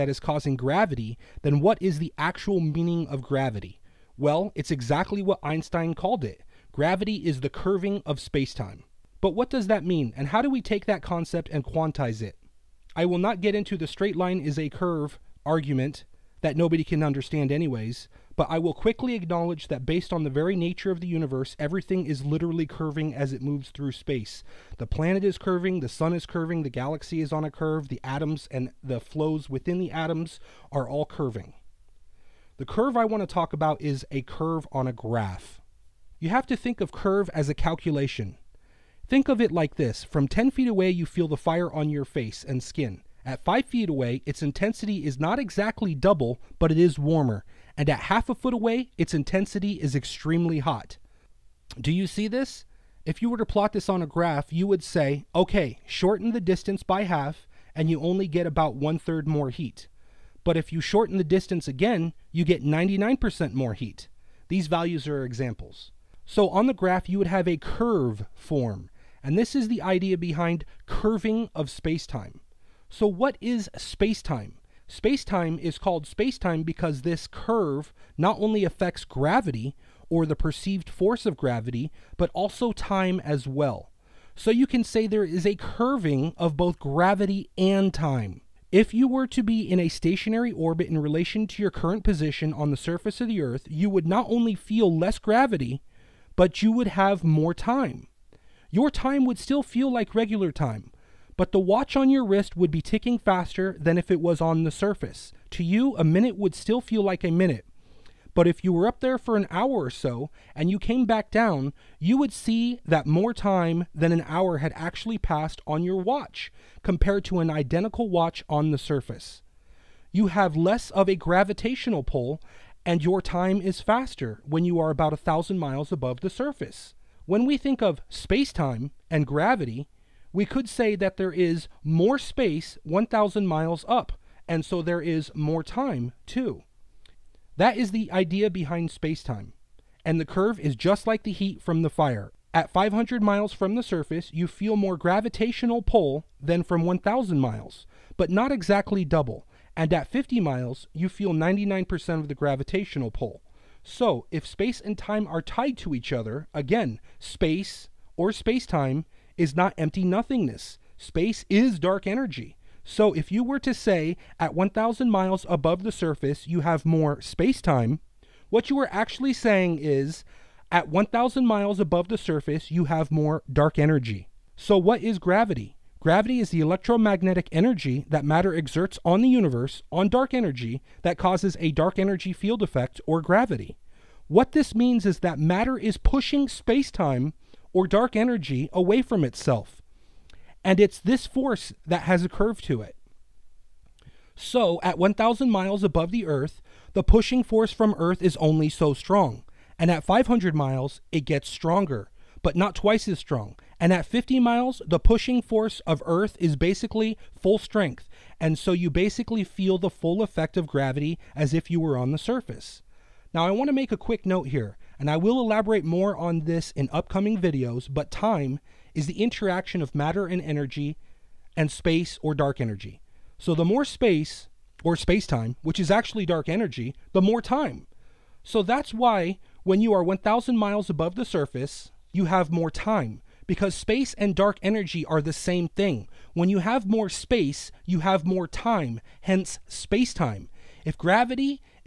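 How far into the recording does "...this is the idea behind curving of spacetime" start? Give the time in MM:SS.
01:09.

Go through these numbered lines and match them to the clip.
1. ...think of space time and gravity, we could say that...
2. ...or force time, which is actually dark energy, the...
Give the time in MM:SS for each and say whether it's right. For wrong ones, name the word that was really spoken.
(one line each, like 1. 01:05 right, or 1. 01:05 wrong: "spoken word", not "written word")
1. 02:07 right
2. 03:44 wrong: "space", not "force".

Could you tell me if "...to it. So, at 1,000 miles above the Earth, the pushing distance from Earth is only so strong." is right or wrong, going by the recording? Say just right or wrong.
wrong.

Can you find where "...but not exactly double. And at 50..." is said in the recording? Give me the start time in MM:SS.
02:28.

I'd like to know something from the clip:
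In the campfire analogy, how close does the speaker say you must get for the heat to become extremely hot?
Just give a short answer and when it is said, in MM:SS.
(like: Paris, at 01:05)
half a foot, at 00:48.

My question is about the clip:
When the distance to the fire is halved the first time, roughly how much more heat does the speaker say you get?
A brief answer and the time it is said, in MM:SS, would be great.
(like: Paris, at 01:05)
about one third more, at 00:58.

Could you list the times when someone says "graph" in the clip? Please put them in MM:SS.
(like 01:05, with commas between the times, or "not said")
00:34, 00:54, 01:06.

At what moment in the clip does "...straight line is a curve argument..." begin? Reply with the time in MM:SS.
00:13.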